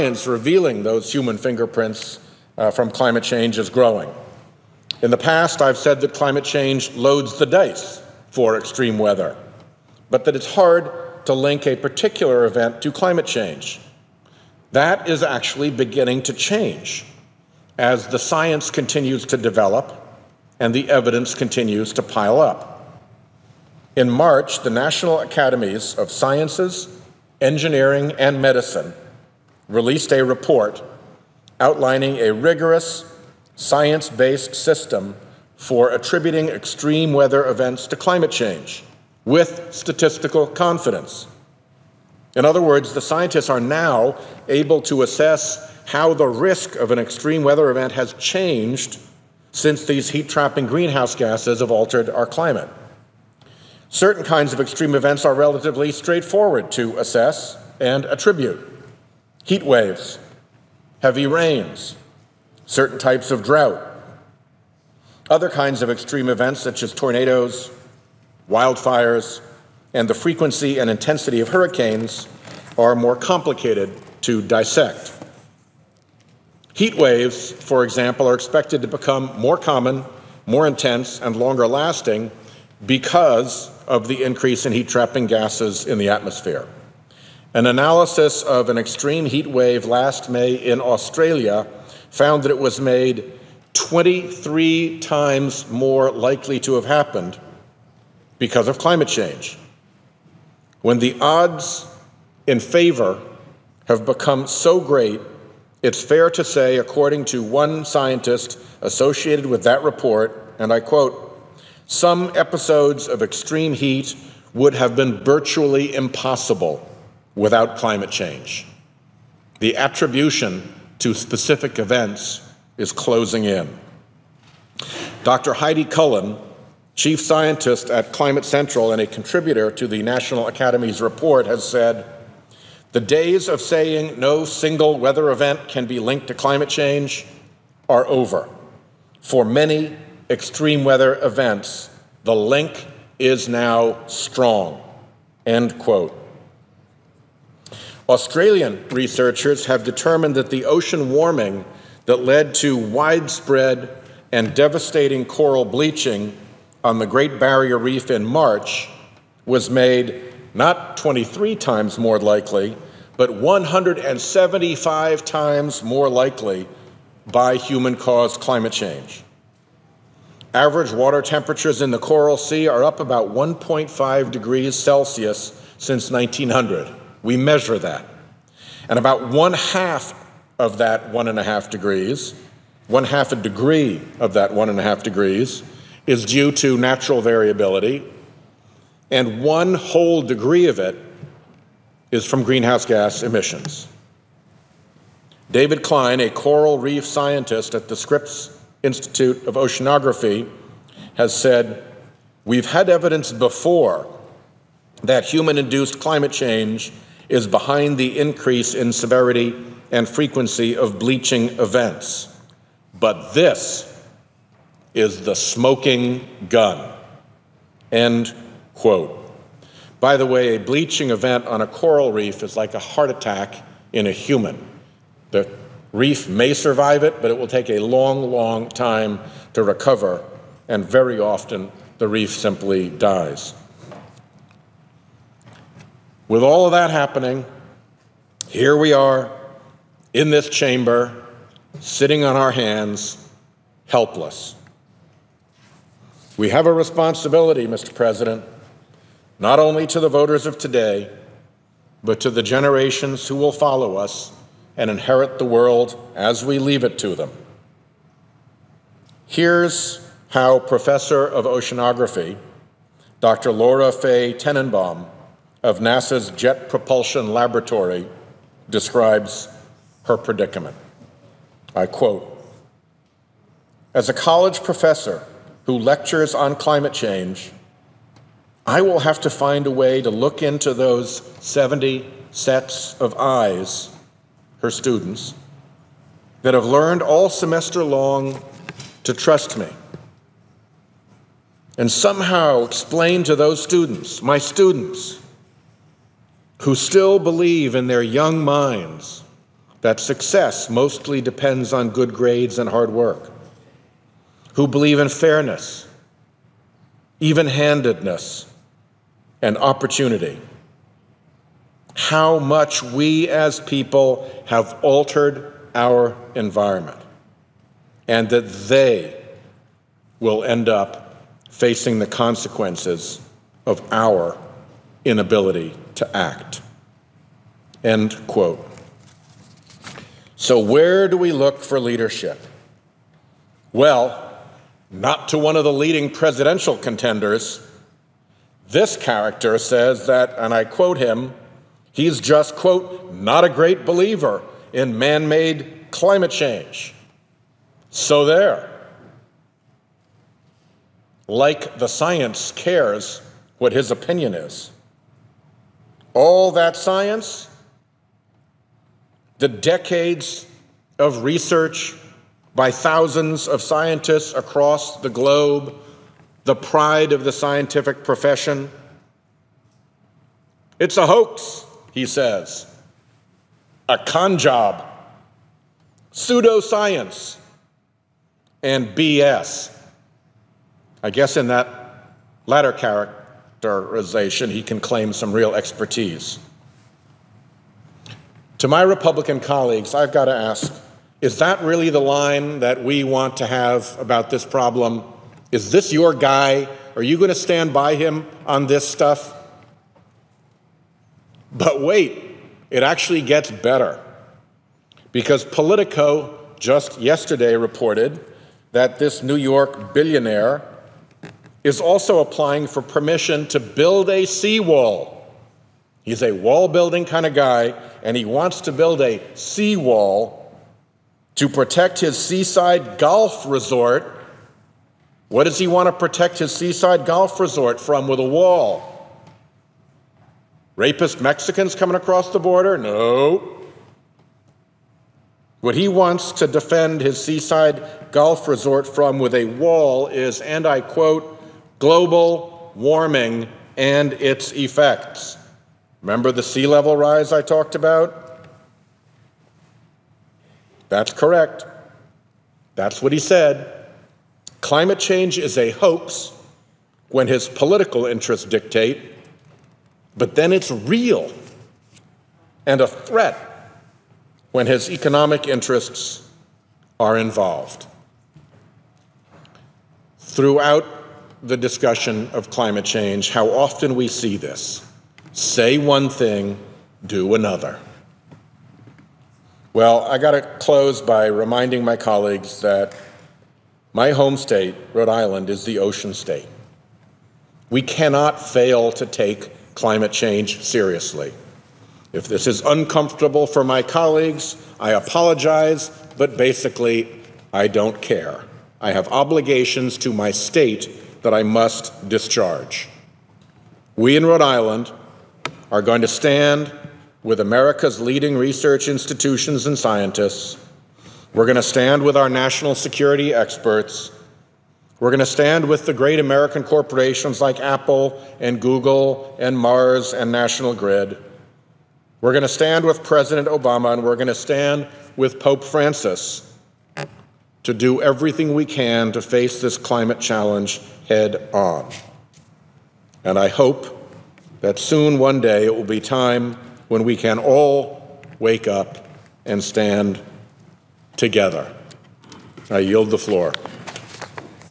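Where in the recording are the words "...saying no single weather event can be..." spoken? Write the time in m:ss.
2:13.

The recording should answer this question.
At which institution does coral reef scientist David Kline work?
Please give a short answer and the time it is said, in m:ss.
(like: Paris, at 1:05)
Scripps Institute of Oceanography, at 3:17.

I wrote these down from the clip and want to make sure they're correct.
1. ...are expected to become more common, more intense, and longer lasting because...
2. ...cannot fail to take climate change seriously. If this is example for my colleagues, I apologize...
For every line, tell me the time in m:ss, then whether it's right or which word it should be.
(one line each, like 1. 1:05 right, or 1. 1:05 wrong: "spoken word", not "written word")
1. 1:18 right
2. 8:07 wrong: "uncomfortable", not "example".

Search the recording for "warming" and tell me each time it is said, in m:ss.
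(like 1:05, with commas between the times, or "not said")
2:31, 7:22.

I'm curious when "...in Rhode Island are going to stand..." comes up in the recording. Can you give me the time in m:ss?
8:24.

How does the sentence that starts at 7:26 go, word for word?
Remember the sea level rise I talked about?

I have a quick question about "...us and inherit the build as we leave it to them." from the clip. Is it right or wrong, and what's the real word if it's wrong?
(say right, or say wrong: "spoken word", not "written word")
wrong: "world", not "build".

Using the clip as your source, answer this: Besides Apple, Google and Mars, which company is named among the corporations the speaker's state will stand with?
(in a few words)
National Grid.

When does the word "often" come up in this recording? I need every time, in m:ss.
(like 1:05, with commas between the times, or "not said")
3:51, 7:53.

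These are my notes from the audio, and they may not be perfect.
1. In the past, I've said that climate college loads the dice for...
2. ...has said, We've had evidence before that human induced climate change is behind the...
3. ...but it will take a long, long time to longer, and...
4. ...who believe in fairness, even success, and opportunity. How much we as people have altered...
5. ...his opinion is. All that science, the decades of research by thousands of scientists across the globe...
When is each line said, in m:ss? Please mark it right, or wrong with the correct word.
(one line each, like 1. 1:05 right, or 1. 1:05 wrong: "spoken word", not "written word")
1. 0:05 wrong: "change", not "college"
2. 3:21 right
3. 3:47 wrong: "recover", not "longer"
4. 5:04 wrong: "handedness", not "success"
5. 5:53 right.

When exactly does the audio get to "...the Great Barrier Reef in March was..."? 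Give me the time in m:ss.
2:36.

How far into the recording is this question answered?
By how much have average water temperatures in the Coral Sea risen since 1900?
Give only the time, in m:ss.
2:53.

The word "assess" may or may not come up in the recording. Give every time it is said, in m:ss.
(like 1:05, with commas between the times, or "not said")
0:45, 0:56.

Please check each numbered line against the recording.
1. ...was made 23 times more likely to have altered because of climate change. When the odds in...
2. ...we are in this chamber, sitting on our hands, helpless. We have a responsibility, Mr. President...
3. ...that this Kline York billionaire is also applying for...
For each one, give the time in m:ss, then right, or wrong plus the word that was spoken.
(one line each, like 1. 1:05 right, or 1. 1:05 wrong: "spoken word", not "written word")
1. 1:32 wrong: "happened", not "altered"
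2. 3:58 right
3. 6:48 wrong: "New", not "Kline".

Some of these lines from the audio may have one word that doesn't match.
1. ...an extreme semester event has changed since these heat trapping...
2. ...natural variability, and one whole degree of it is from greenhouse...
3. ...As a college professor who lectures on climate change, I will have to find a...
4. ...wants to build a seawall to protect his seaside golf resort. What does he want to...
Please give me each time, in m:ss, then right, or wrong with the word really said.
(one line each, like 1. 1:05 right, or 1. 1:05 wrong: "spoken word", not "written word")
1. 0:46 wrong: "weather", not "semester"
2. 3:06 right
3. 4:33 right
4. 6:58 right.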